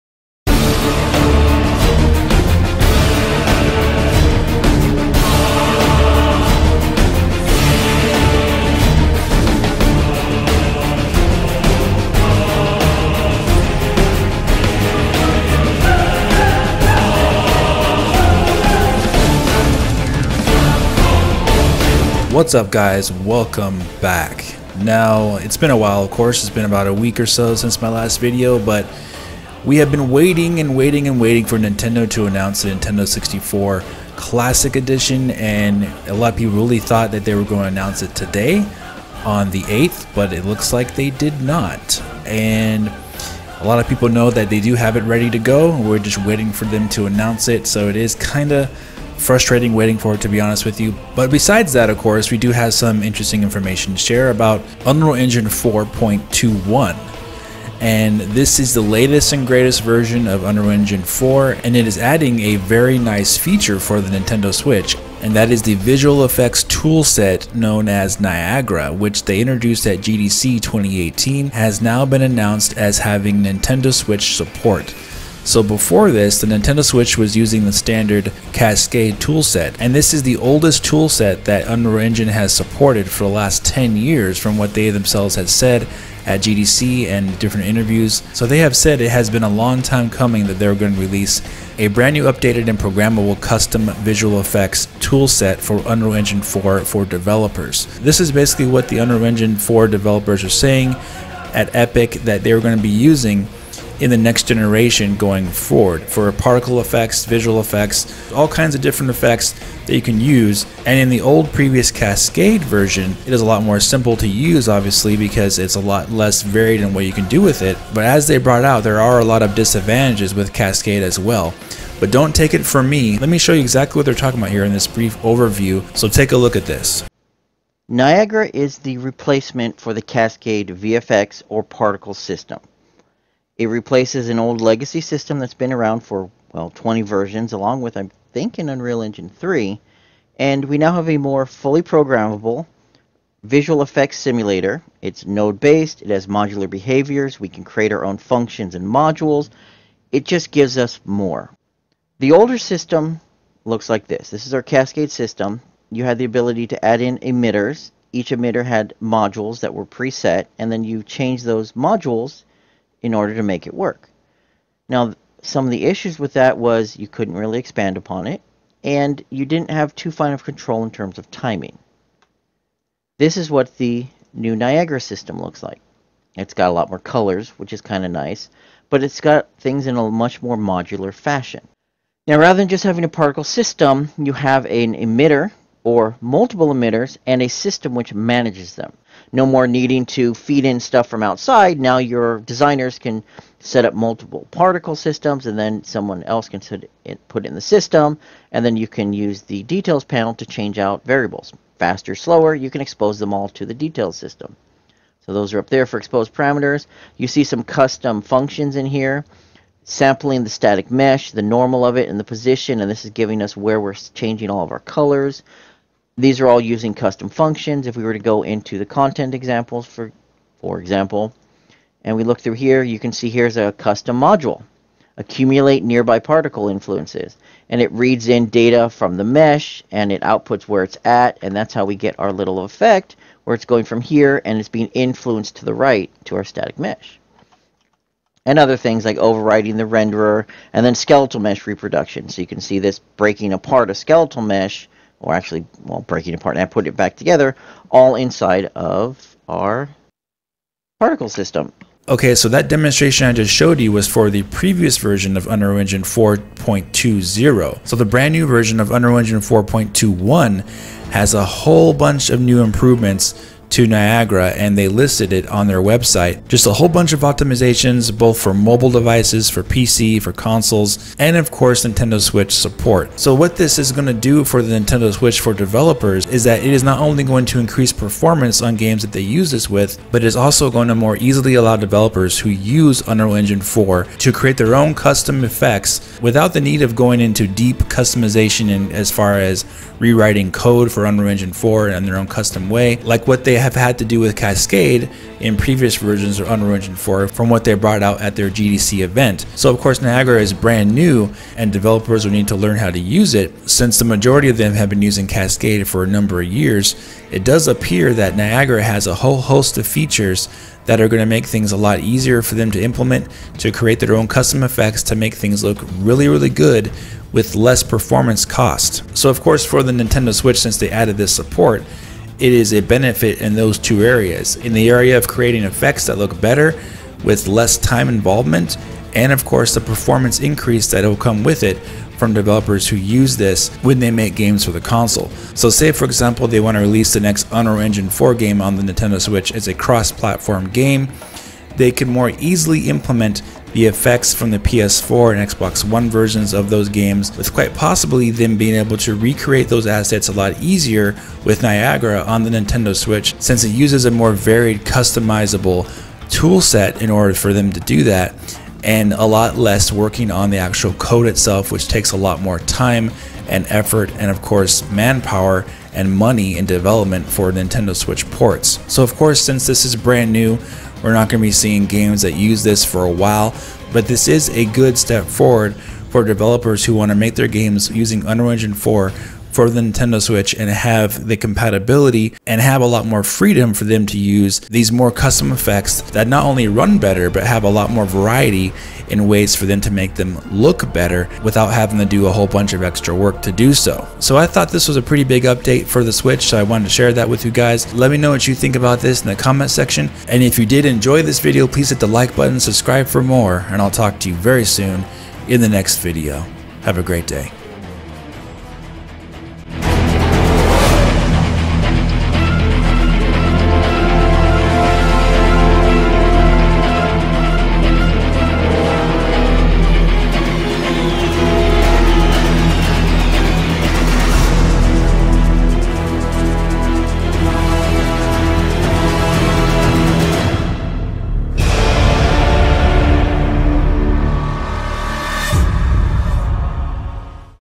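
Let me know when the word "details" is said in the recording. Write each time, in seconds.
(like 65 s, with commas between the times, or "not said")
199 s, 203 s.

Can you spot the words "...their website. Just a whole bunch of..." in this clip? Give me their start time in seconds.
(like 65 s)
265 s.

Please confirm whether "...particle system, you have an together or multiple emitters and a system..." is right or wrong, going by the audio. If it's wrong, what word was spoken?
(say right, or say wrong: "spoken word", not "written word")
wrong: "emitter", not "together".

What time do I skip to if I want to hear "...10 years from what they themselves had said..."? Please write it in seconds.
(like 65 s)
83 s.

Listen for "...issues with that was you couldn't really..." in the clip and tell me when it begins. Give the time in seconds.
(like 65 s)
165 s.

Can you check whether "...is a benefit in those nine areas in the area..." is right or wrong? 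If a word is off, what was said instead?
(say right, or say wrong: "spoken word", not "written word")
wrong: "two", not "nine".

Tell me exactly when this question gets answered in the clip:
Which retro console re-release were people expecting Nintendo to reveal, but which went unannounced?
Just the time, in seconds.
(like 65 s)
32 s.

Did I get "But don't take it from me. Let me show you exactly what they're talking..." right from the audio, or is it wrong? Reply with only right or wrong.
right.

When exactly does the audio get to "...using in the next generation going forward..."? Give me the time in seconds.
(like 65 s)
102 s.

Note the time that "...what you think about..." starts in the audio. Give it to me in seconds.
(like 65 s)
398 s.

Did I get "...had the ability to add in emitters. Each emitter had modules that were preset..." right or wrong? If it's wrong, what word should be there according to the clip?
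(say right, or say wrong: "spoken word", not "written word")
right.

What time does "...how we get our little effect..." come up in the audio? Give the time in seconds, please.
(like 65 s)
231 s.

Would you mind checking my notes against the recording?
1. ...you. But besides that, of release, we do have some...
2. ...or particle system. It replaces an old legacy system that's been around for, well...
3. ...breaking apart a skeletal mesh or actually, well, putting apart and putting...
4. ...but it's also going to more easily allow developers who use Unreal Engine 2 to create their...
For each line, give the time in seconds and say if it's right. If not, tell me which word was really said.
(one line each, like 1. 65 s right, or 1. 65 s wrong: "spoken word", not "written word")
1. 50 s wrong: "course", not "release"
2. 131 s right
3. 242 s wrong: "breaking", not "putting"
4. 280 s wrong: "4", not "2".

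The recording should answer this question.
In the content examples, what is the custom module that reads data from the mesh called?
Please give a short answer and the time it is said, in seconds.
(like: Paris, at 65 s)
Accumulate nearby particle influences, at 225 s.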